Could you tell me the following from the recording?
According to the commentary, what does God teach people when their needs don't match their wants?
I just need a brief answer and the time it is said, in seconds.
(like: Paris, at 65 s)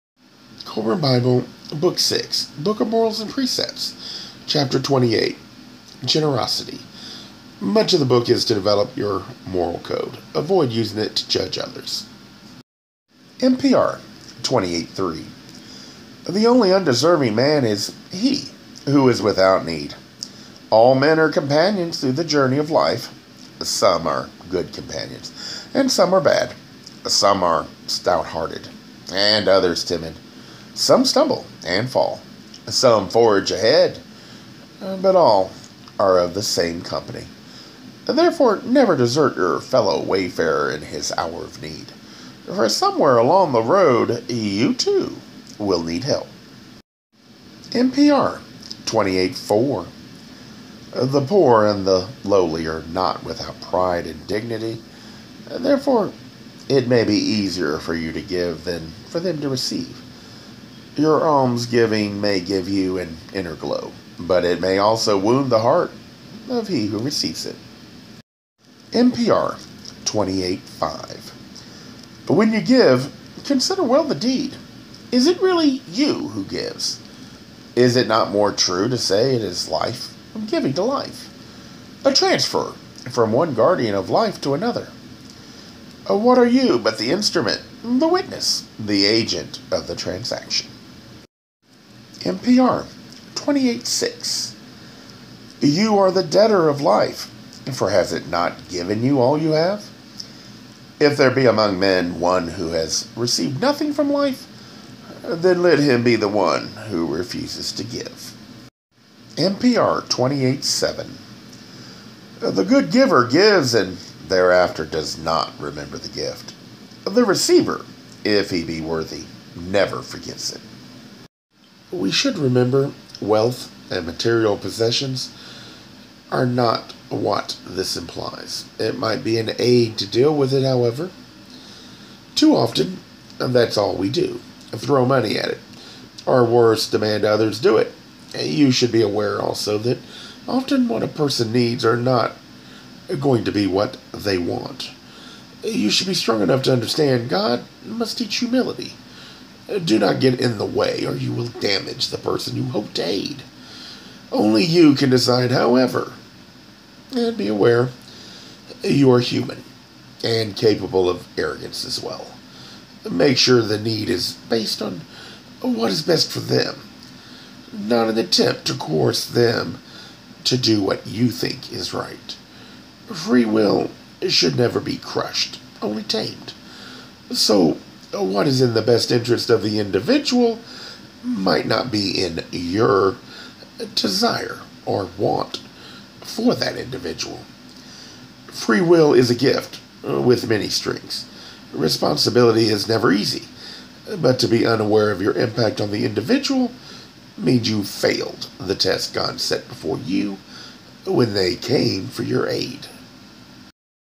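Humility, at 148 s.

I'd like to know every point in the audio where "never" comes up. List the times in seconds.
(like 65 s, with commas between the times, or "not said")
38 s, 119 s, 174 s, 192 s.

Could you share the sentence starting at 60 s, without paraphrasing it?
Your almsgiving may give you an inner glow, but it may also wound the heart of he who receives it.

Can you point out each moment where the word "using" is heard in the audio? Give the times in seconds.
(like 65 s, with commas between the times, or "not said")
10 s.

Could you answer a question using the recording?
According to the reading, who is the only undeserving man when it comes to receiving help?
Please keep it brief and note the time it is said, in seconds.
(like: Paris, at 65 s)
He who is without need, at 18 s.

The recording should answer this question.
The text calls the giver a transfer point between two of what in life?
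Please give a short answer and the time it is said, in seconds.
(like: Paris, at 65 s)
Guardian, at 83 s.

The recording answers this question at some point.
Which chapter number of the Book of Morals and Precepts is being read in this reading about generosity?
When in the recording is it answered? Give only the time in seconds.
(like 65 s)
4 s.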